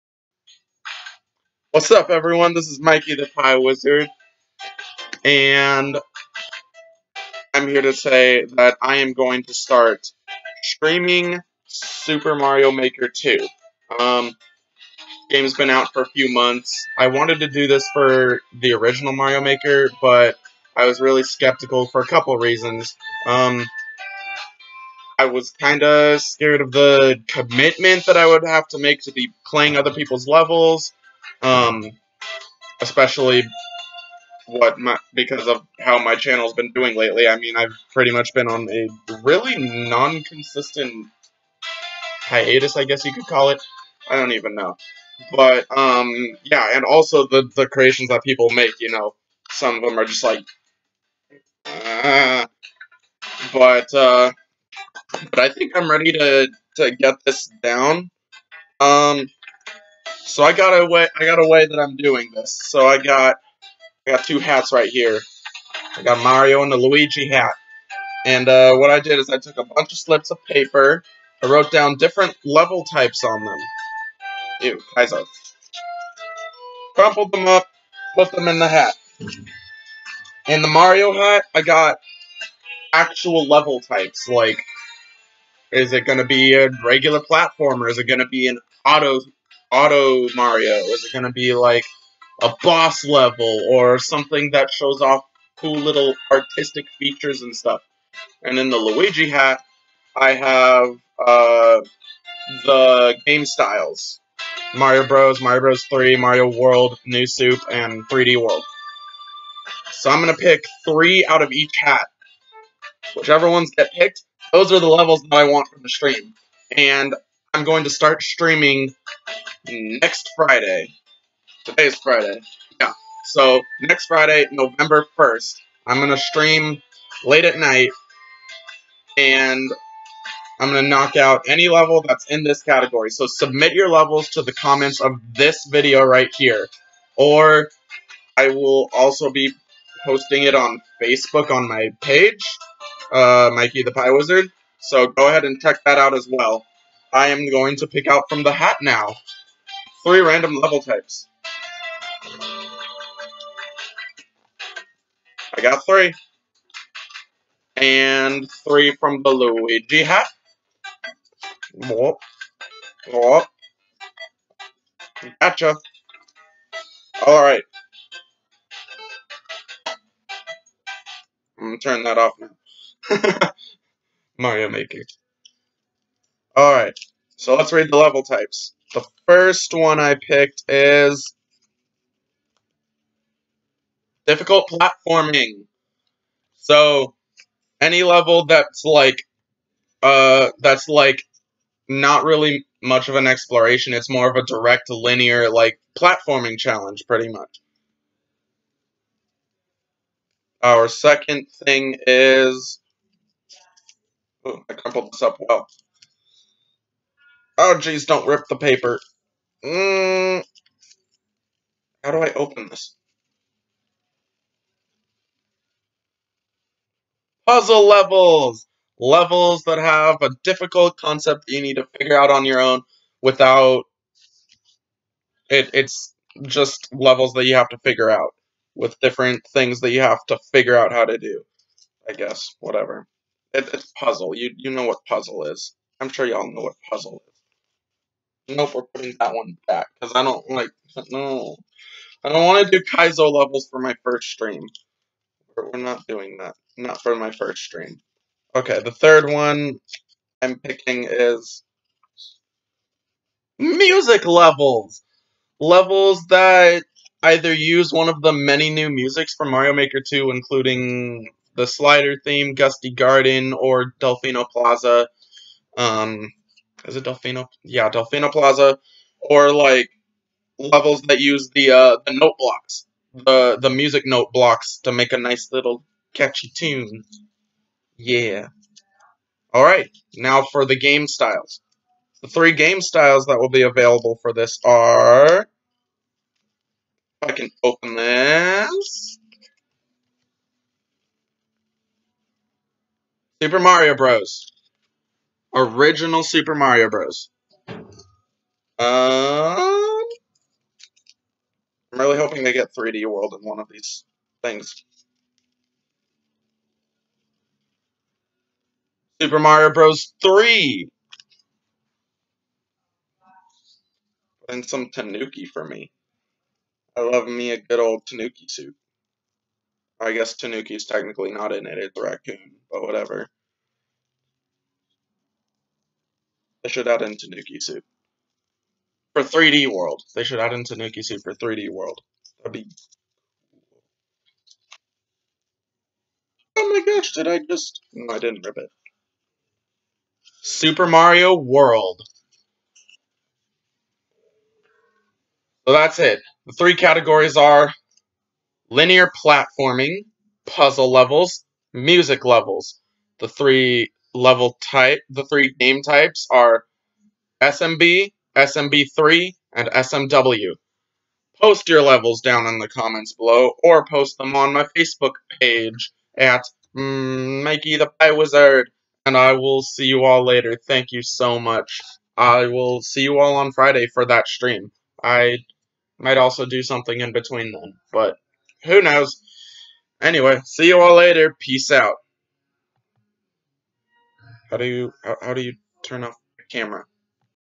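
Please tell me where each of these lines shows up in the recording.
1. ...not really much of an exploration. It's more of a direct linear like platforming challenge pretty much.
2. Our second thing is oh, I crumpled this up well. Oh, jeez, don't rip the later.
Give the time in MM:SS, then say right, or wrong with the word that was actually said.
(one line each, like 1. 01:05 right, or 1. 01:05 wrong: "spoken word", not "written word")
1. 03:11 right
2. 03:20 wrong: "paper", not "later".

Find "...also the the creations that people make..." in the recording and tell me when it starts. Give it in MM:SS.
00:46.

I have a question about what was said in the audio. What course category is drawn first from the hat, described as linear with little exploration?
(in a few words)
Difficult platforming.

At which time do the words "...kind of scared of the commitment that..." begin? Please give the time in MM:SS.
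00:25.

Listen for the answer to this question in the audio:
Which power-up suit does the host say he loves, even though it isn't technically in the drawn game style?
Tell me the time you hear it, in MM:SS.
05:18.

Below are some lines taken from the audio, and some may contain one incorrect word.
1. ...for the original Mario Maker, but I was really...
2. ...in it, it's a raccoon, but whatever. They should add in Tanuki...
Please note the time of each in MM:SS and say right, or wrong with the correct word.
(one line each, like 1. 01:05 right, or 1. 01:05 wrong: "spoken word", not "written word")
1. 00:17 right
2. 05:21 right.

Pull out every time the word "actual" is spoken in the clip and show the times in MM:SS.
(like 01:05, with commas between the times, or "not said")
01:22.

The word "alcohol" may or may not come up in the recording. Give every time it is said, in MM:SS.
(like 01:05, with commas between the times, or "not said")
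not said.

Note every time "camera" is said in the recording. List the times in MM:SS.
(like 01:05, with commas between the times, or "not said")
06:26.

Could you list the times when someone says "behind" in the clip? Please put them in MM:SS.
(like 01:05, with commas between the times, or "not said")
not said.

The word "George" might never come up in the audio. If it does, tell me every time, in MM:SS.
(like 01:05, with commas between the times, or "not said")
not said.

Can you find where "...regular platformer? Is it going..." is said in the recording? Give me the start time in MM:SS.
01:26.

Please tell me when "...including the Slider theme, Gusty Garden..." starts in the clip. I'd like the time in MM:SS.
04:20.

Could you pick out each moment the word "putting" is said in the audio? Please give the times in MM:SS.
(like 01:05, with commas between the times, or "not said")
03:58.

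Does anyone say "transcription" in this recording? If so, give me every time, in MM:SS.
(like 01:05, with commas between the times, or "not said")
not said.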